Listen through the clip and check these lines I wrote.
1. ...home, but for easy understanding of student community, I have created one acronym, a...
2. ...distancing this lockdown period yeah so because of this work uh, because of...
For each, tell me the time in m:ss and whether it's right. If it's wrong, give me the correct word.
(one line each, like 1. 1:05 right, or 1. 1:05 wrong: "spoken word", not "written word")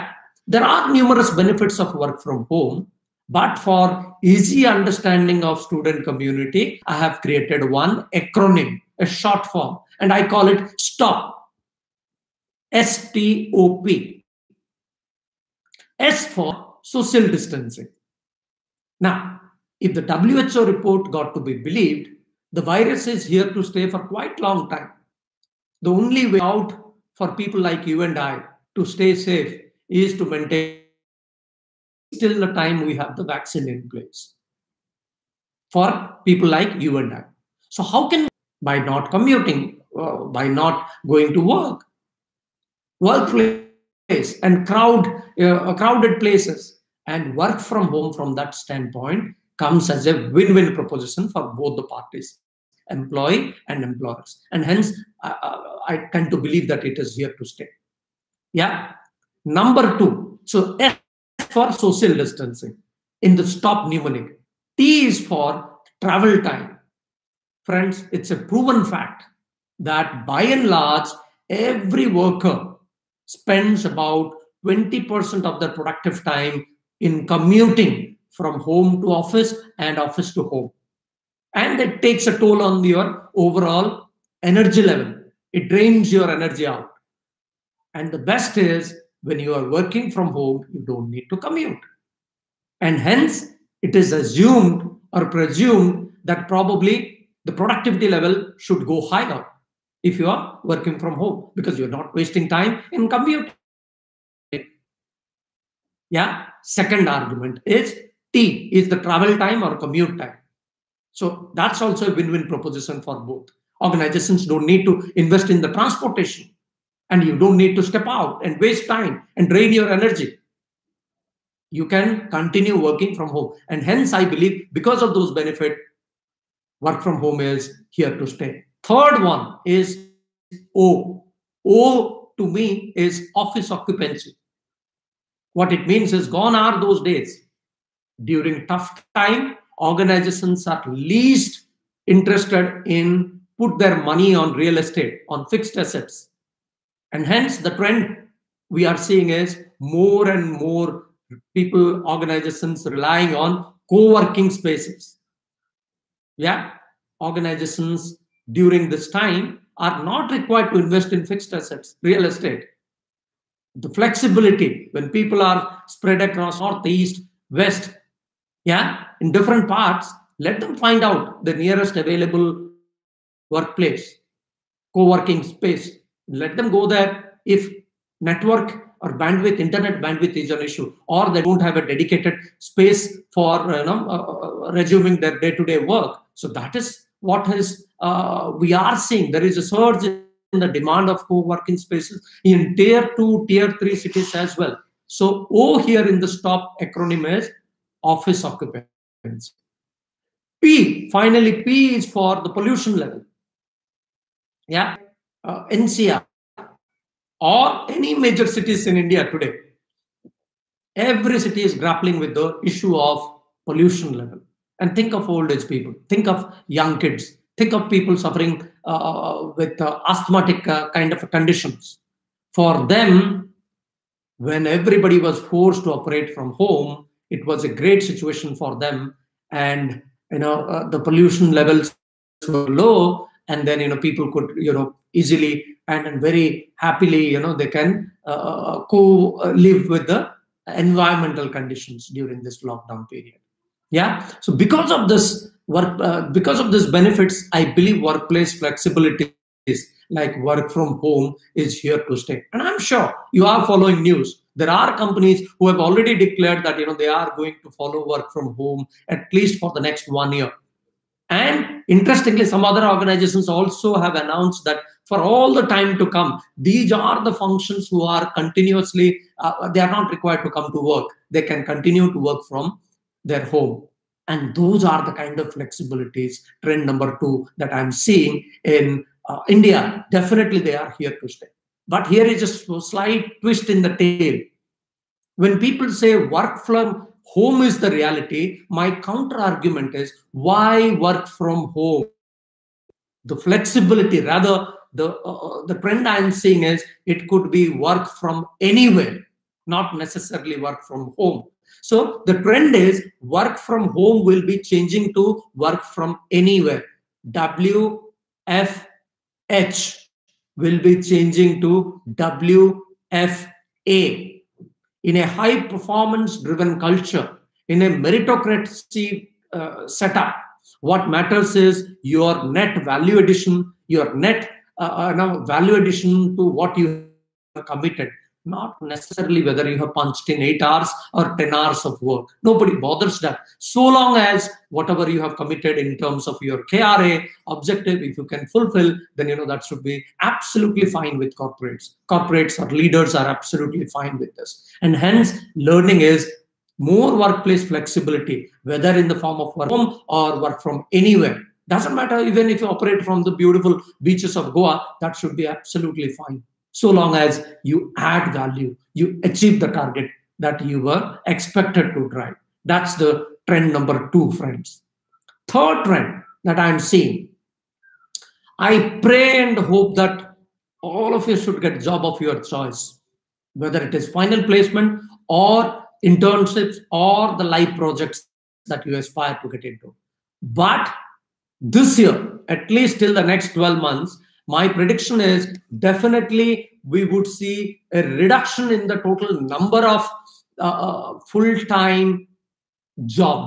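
1. 0:02 right
2. 4:02 wrong: "during", not "distancing".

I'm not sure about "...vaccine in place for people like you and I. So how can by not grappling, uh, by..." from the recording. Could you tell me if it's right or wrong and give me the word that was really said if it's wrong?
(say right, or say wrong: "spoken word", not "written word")
wrong: "commuting", not "grappling".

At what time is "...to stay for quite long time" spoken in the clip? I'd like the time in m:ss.
0:23.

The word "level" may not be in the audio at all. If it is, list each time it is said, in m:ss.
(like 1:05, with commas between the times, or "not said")
1:24, 1:38, 3:22, 3:34, 3:51.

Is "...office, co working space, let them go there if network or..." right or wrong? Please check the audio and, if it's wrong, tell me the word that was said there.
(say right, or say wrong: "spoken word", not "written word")
wrong: "workplace", not "office".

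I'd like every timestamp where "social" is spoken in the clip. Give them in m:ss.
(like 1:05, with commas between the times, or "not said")
0:16, 1:01.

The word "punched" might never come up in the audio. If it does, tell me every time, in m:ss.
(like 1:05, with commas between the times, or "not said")
5:29.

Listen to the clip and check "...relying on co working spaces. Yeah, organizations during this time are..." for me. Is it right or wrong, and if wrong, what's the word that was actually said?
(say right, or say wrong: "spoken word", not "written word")
right.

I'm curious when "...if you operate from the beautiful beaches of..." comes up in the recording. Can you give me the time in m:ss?
5:52.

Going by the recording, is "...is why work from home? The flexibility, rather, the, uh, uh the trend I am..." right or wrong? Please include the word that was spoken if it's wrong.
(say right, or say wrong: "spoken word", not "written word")
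right.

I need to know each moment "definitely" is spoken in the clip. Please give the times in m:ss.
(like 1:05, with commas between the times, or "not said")
4:40, 6:25.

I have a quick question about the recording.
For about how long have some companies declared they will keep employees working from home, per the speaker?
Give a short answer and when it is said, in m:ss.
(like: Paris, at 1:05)
one year, at 4:19.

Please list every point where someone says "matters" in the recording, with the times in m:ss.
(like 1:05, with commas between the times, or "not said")
5:21, 5:51.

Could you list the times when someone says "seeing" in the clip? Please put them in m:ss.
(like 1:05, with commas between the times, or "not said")
2:28, 3:08, 4:37, 4:56, 6:06.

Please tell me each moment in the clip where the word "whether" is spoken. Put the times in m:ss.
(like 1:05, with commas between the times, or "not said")
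5:29, 5:48, 6:13.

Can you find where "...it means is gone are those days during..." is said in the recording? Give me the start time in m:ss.
2:15.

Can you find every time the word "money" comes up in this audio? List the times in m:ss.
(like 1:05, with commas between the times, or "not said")
2:24.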